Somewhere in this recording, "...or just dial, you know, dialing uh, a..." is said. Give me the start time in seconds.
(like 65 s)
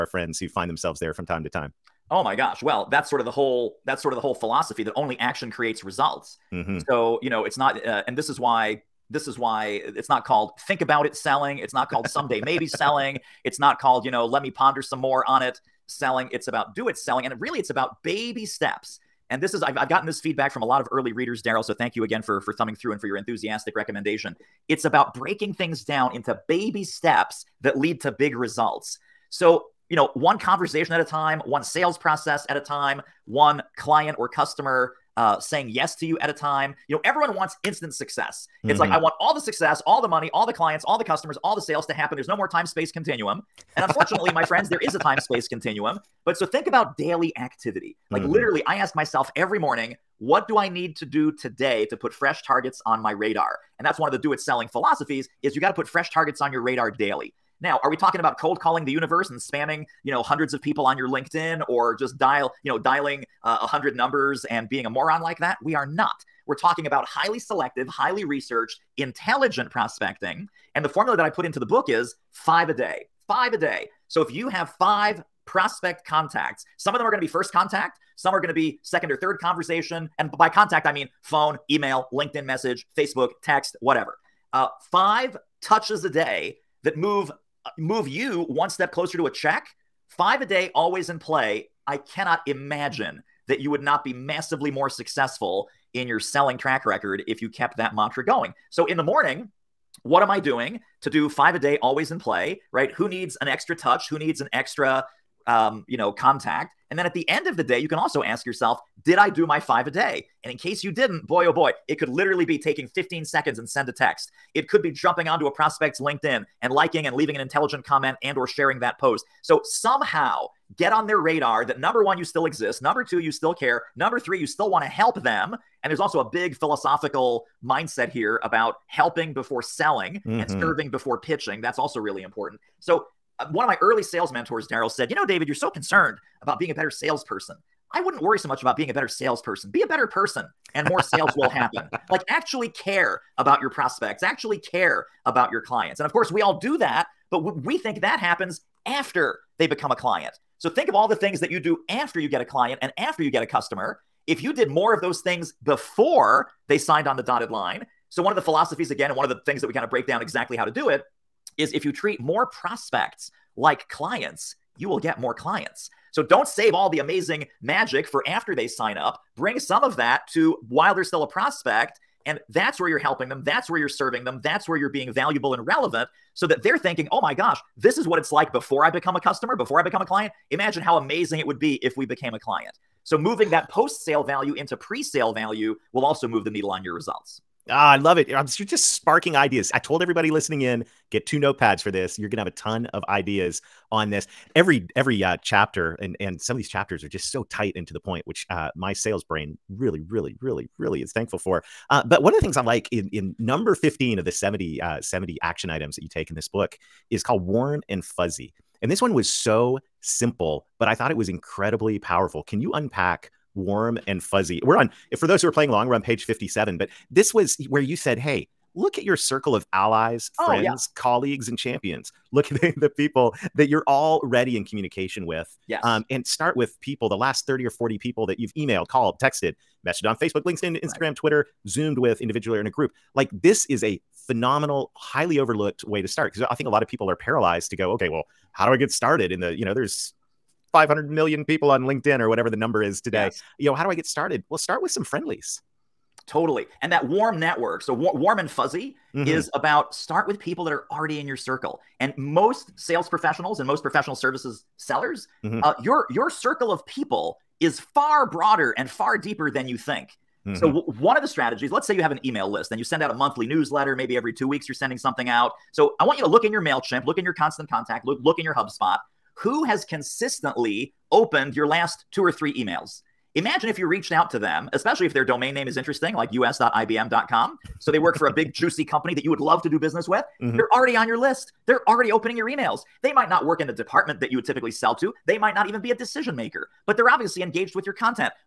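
61 s.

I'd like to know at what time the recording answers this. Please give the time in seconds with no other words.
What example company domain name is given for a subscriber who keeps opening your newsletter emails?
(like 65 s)
276 s.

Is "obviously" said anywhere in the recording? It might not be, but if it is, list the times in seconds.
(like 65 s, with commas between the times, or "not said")
287 s.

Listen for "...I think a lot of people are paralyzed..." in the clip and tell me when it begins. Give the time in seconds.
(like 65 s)
236 s.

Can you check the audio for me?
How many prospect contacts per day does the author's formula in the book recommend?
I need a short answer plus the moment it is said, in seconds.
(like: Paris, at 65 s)
5, at 72 s.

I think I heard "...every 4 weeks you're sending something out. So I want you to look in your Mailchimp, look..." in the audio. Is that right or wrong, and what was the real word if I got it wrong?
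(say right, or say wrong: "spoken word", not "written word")
wrong: "2", not "4".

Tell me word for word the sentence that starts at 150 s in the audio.
So think of all the things that you do after you get a client and after you get a customer.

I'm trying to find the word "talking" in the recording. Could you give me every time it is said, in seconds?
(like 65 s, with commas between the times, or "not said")
57 s, 66 s.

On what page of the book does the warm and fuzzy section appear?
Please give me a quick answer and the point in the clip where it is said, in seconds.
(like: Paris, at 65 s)
57, at 216 s.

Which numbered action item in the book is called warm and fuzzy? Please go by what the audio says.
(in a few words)
15.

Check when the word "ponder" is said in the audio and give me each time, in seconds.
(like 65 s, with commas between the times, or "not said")
14 s.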